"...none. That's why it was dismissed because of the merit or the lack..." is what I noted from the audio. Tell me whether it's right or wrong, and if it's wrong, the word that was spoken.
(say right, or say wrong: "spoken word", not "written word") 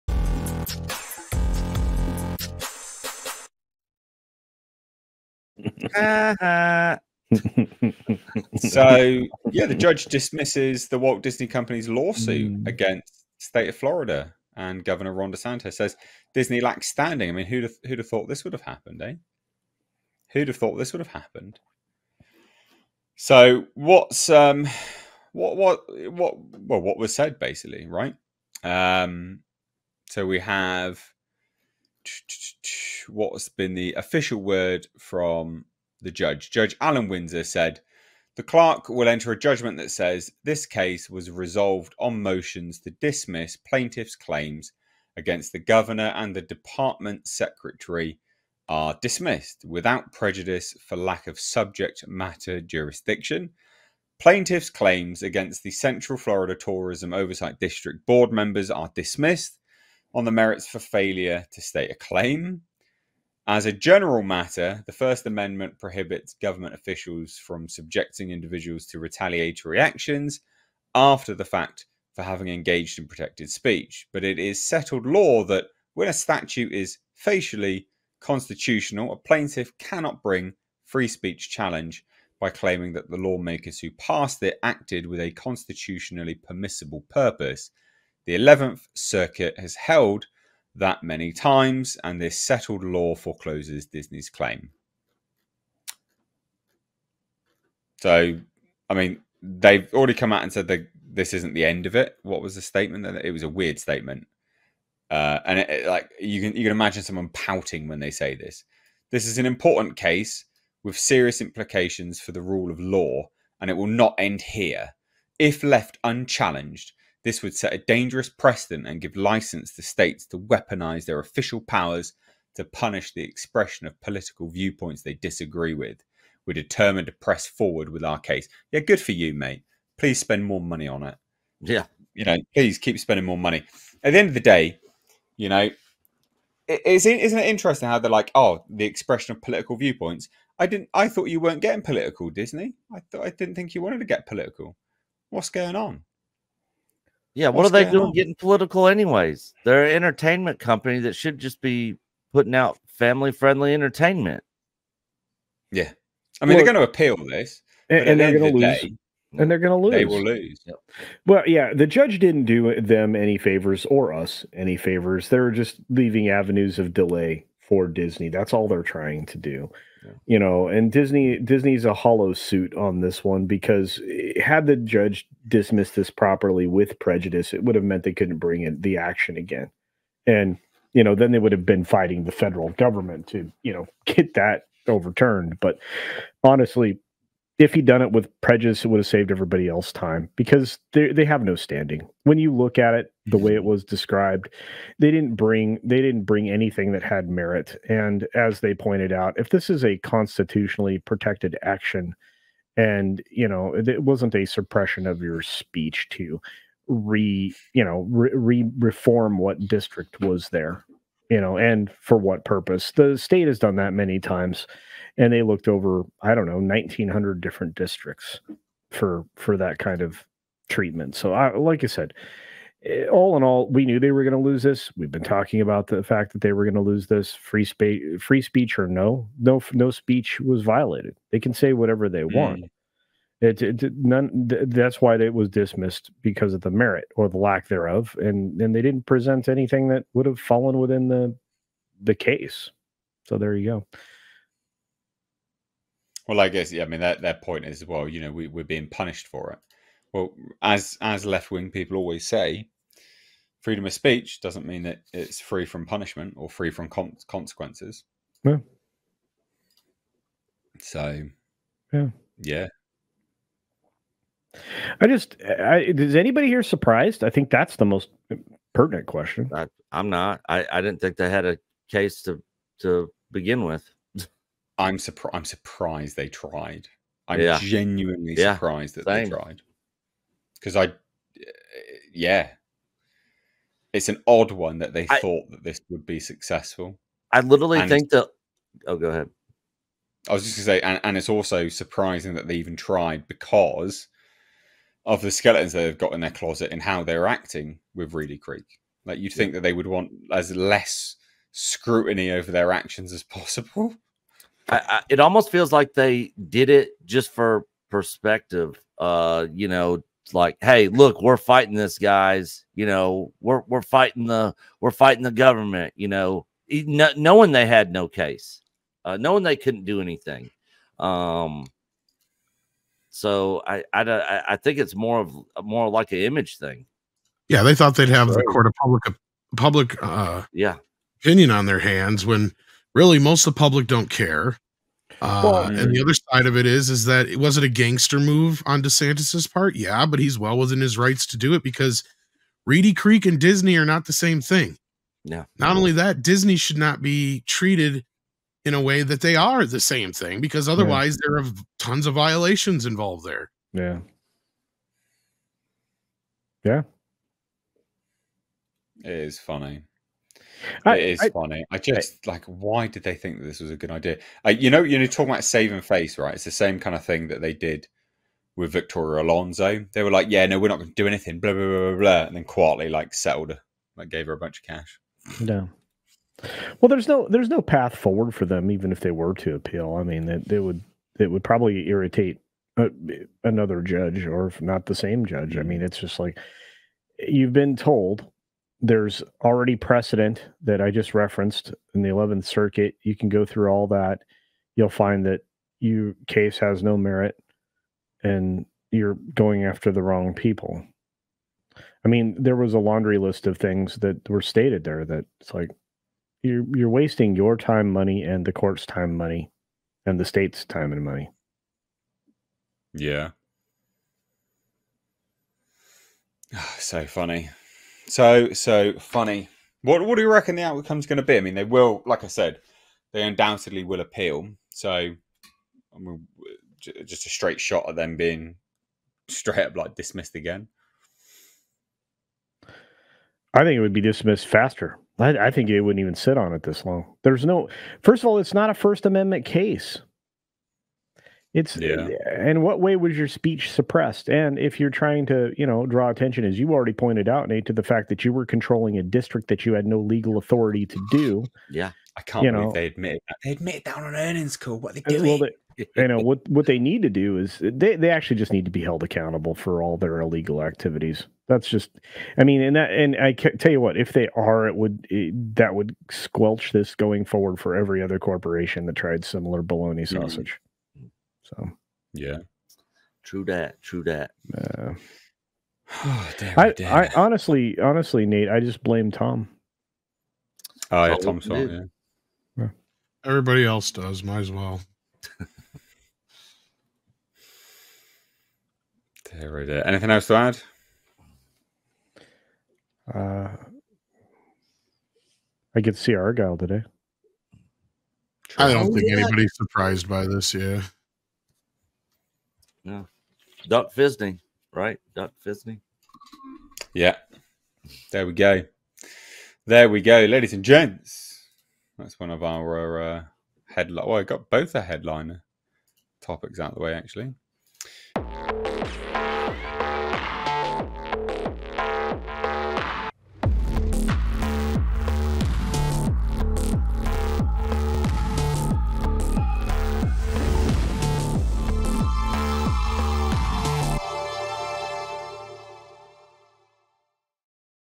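right.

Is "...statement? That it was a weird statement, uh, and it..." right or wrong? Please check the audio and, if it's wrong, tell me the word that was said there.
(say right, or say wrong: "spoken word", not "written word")
right.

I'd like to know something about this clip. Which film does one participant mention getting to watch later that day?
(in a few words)
Argylle.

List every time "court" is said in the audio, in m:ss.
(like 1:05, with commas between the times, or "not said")
5:28, 6:48.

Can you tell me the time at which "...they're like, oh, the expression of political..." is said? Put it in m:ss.
2:17.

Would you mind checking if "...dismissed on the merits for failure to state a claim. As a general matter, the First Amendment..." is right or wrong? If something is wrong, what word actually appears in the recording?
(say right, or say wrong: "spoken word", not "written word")
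right.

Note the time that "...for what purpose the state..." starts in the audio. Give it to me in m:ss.
3:32.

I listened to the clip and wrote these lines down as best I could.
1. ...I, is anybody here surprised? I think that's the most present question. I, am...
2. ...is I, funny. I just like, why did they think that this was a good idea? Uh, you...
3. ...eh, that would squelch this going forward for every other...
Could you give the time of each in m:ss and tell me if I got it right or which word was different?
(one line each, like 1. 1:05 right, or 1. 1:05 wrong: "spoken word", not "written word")
1. 4:25 wrong: "pertinent", not "present"
2. 6:01 right
3. 7:45 right.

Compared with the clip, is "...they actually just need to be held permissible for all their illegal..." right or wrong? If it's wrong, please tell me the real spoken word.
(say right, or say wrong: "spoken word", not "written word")
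wrong: "accountable", not "permissible".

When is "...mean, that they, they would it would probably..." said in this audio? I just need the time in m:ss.
6:20.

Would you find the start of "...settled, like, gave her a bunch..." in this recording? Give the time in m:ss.
6:13.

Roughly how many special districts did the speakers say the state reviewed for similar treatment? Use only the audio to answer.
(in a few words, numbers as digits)
1900.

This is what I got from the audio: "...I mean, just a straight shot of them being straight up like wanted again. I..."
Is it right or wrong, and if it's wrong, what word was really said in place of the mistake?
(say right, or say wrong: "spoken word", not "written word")
wrong: "dismissed", not "wanted".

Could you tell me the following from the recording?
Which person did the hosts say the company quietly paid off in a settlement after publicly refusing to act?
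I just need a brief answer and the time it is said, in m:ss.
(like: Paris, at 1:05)
Victoria Alonso, at 6:08.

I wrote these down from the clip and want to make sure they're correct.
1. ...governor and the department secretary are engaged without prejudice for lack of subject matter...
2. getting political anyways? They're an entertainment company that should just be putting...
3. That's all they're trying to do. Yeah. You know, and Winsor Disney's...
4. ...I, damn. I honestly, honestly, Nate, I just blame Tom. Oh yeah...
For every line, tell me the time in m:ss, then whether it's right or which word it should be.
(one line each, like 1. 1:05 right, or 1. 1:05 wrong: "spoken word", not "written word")
1. 0:45 wrong: "dismissed", not "engaged"
2. 2:28 right
3. 2:48 wrong: "Disney", not "Winsor"
4. 7:56 right.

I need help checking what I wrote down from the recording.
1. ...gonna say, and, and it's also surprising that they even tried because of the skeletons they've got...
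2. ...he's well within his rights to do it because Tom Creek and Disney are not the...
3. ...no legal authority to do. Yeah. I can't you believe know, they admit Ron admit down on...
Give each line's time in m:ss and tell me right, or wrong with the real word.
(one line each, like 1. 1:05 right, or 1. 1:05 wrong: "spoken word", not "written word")
1. 4:50 right
2. 5:40 wrong: "Reedy", not "Tom"
3. 7:29 wrong: "They", not "Ron".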